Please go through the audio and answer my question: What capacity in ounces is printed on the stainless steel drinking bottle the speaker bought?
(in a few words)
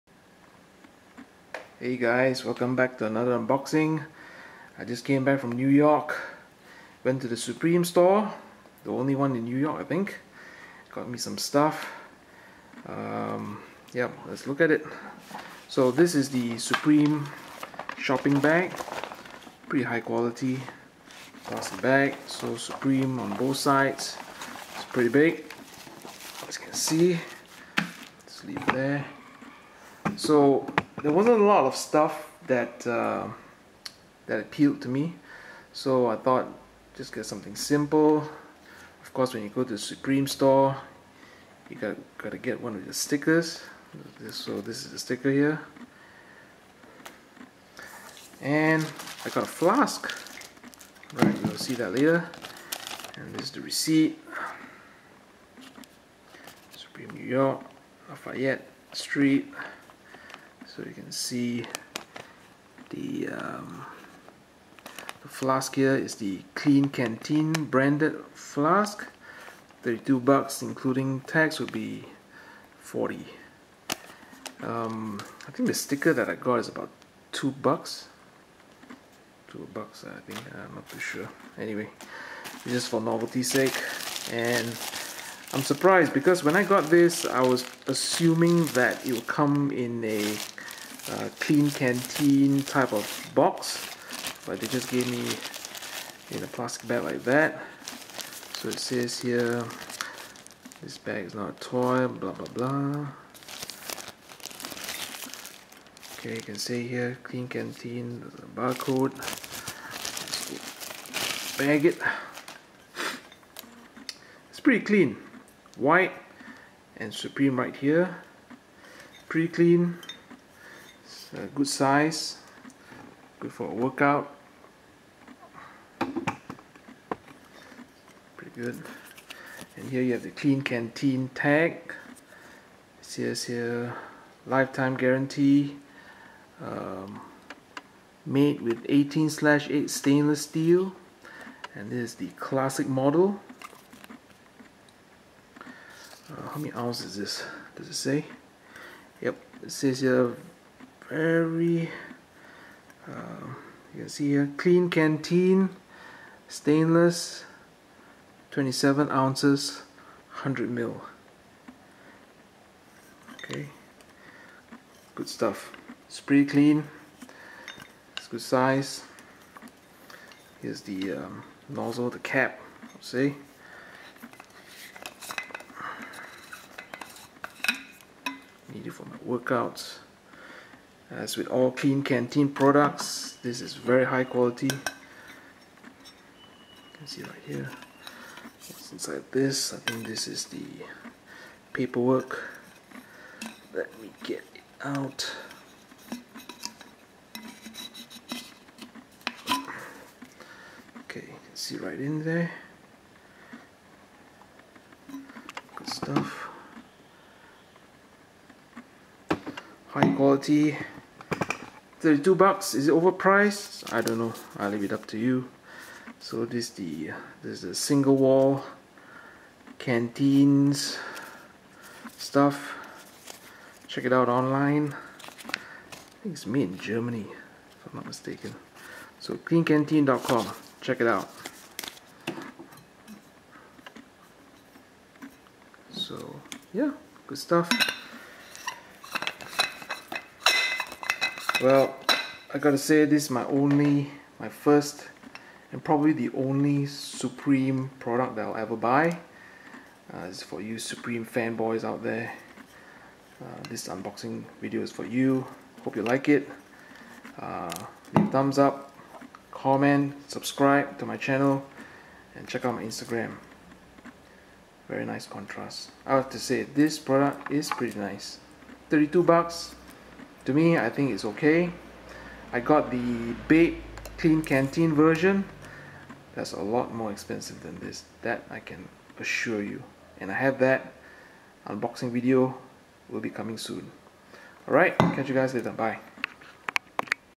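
27 ounces.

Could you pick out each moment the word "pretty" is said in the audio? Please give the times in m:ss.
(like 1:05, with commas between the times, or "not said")
0:19, 0:24, 1:54, 1:59, 2:08, 2:46, 4:27.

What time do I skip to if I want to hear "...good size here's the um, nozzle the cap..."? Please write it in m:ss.
2:48.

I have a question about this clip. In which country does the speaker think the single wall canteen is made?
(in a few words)
Germany.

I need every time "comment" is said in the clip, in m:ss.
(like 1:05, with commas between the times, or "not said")
4:19.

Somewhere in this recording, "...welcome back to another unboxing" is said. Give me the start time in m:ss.
0:02.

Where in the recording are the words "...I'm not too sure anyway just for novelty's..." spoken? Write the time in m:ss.
1:20.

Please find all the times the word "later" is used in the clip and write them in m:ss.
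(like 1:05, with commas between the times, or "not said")
0:51, 4:45.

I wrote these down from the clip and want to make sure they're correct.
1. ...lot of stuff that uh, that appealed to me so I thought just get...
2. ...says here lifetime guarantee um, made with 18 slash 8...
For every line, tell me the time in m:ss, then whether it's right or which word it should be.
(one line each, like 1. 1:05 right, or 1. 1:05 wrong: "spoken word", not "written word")
1. 0:31 right
2. 2:13 right.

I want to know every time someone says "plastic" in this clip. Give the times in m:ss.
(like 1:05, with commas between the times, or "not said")
0:21, 1:36.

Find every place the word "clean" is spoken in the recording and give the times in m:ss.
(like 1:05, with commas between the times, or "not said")
1:54, 1:59, 2:46.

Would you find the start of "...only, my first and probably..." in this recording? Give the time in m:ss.
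4:03.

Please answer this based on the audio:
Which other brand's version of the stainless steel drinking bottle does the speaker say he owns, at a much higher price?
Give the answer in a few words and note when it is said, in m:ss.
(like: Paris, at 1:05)
BAPE, at 4:33.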